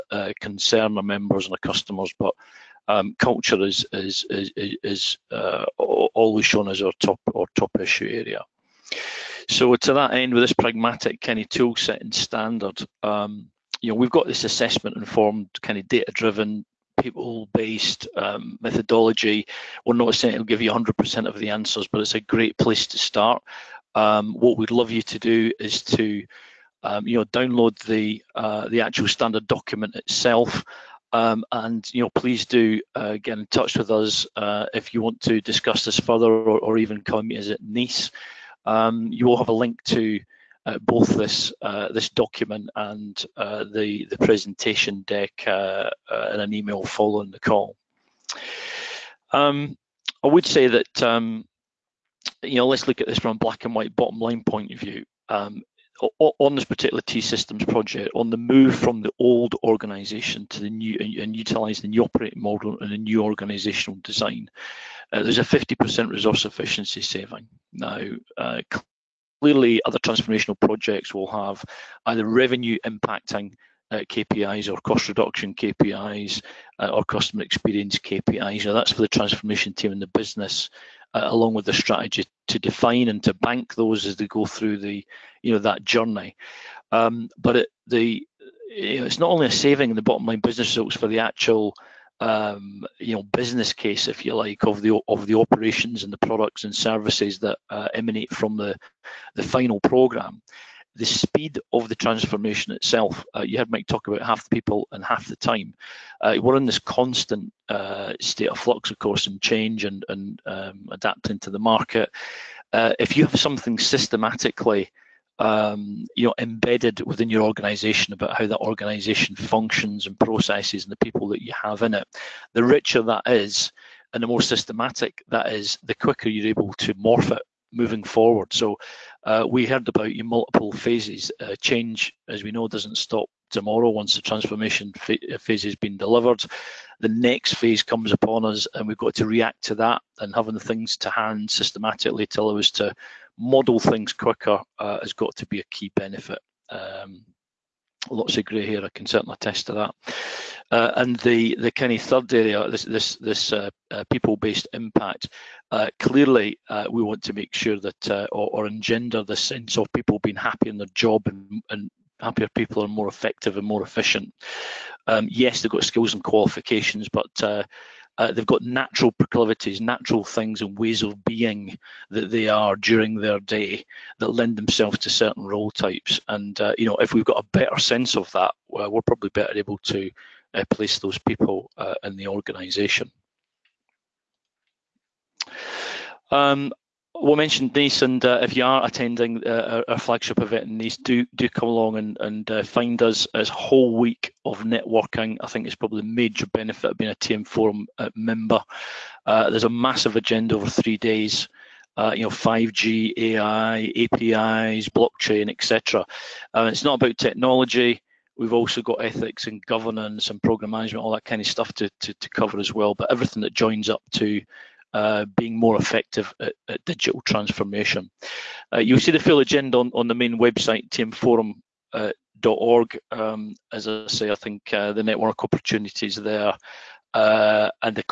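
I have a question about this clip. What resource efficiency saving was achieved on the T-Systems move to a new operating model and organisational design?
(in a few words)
50%.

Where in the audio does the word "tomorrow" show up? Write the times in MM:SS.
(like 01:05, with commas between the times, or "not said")
02:13.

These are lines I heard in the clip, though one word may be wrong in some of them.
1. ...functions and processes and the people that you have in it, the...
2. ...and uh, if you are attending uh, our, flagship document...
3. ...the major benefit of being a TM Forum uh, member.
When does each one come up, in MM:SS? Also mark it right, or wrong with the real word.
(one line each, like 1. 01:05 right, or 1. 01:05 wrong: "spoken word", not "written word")
1. 01:59 right
2. 03:08 wrong: "event", not "document"
3. 03:16 right.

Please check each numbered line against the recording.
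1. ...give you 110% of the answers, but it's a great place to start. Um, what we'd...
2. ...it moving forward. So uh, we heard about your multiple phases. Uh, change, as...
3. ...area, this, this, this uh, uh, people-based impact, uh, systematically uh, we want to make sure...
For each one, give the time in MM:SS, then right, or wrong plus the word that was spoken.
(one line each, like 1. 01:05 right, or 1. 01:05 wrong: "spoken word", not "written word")
1. 00:20 wrong: "100", not "110"
2. 02:07 right
3. 02:32 wrong: "clearly", not "systematically".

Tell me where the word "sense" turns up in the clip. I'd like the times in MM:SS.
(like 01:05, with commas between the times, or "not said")
02:39, 02:57.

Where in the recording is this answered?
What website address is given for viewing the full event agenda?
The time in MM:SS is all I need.
03:40.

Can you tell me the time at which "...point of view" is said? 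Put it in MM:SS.
00:54.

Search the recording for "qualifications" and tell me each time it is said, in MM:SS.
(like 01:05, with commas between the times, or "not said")
02:46.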